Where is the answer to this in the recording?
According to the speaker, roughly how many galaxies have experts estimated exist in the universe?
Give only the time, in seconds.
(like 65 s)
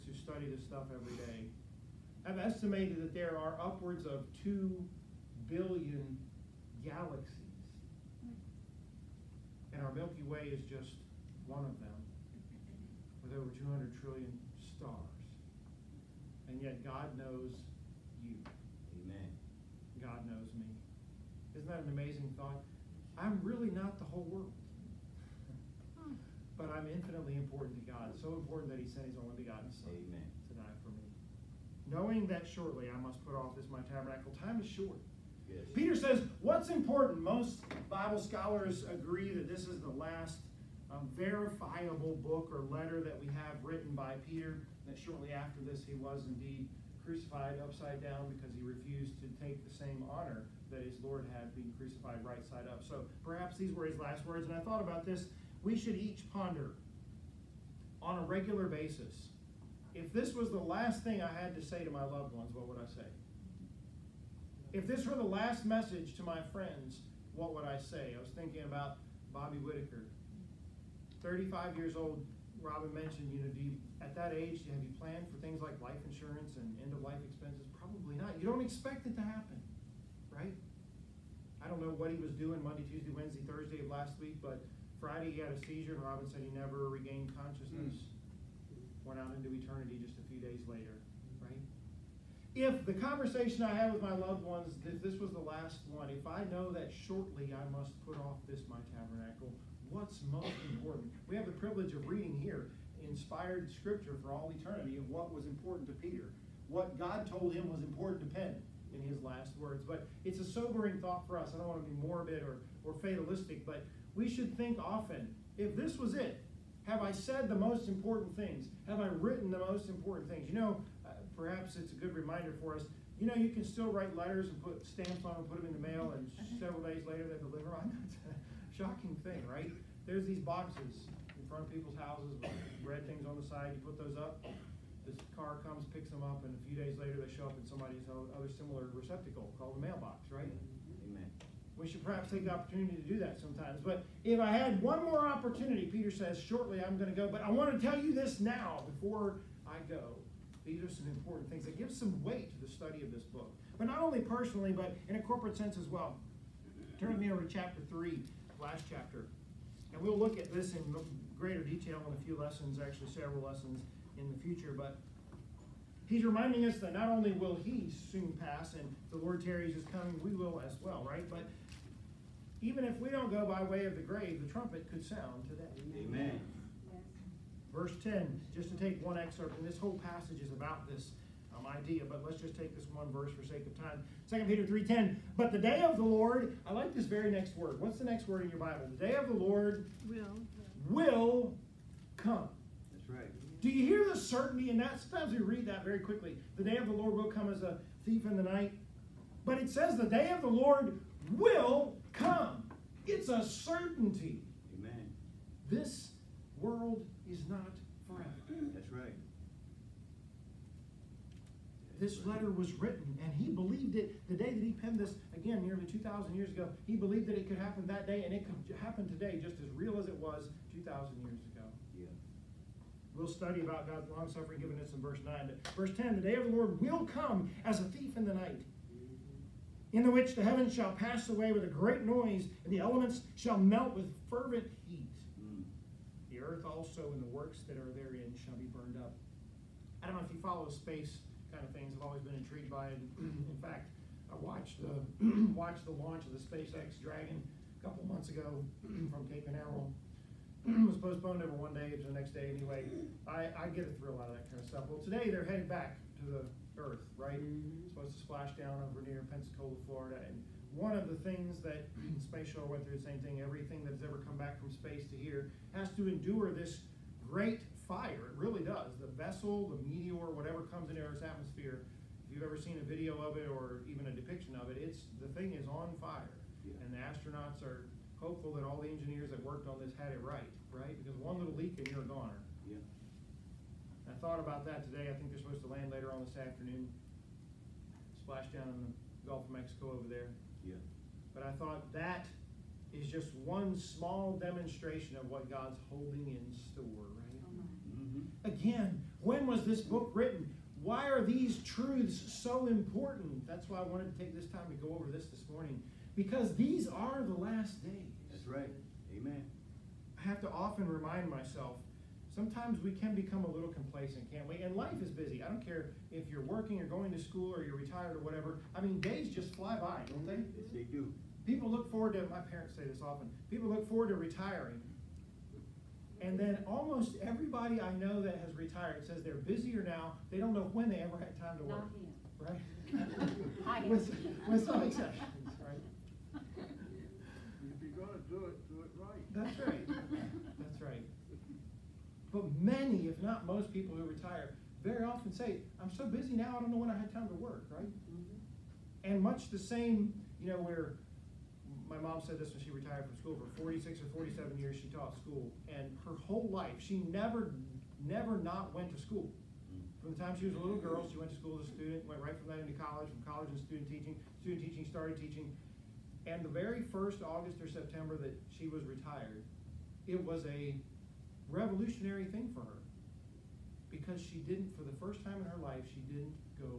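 4 s.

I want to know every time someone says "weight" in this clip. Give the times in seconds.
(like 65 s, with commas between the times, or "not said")
152 s.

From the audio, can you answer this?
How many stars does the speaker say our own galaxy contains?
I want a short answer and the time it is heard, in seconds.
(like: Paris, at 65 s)
over 200 trillion, at 13 s.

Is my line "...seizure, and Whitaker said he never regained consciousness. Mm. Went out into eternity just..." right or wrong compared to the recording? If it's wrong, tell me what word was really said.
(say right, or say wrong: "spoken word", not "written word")
wrong: "Robin", not "Whitaker".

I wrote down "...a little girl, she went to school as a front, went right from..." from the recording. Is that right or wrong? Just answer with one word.
wrong.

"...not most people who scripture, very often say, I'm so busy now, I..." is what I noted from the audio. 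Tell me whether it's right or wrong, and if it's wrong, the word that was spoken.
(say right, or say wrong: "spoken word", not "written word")
wrong: "retire", not "scripture".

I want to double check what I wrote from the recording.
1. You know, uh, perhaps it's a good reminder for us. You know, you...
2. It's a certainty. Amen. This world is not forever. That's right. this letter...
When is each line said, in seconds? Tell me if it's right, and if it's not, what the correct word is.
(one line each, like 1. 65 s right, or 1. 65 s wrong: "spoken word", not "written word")
1. 120 s right
2. 203 s right.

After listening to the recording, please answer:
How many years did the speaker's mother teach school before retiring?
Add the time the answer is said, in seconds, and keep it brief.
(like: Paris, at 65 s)
46 or 47, at 353 s.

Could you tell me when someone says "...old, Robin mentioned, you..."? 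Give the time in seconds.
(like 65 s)
71 s.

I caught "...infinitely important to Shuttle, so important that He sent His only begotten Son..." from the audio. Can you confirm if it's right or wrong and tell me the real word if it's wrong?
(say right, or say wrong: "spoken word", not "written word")
wrong: "God", not "Shuttle".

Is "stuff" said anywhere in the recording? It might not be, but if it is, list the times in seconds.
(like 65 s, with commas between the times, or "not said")
0 s, 254 s.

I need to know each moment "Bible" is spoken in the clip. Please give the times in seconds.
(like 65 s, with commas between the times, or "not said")
37 s, 188 s.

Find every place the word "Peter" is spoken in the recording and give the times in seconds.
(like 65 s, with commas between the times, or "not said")
35 s, 44 s, 105 s, 145 s, 184 s.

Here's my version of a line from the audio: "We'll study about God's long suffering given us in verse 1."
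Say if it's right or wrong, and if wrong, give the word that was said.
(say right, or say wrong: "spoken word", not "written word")
wrong: "9", not "1".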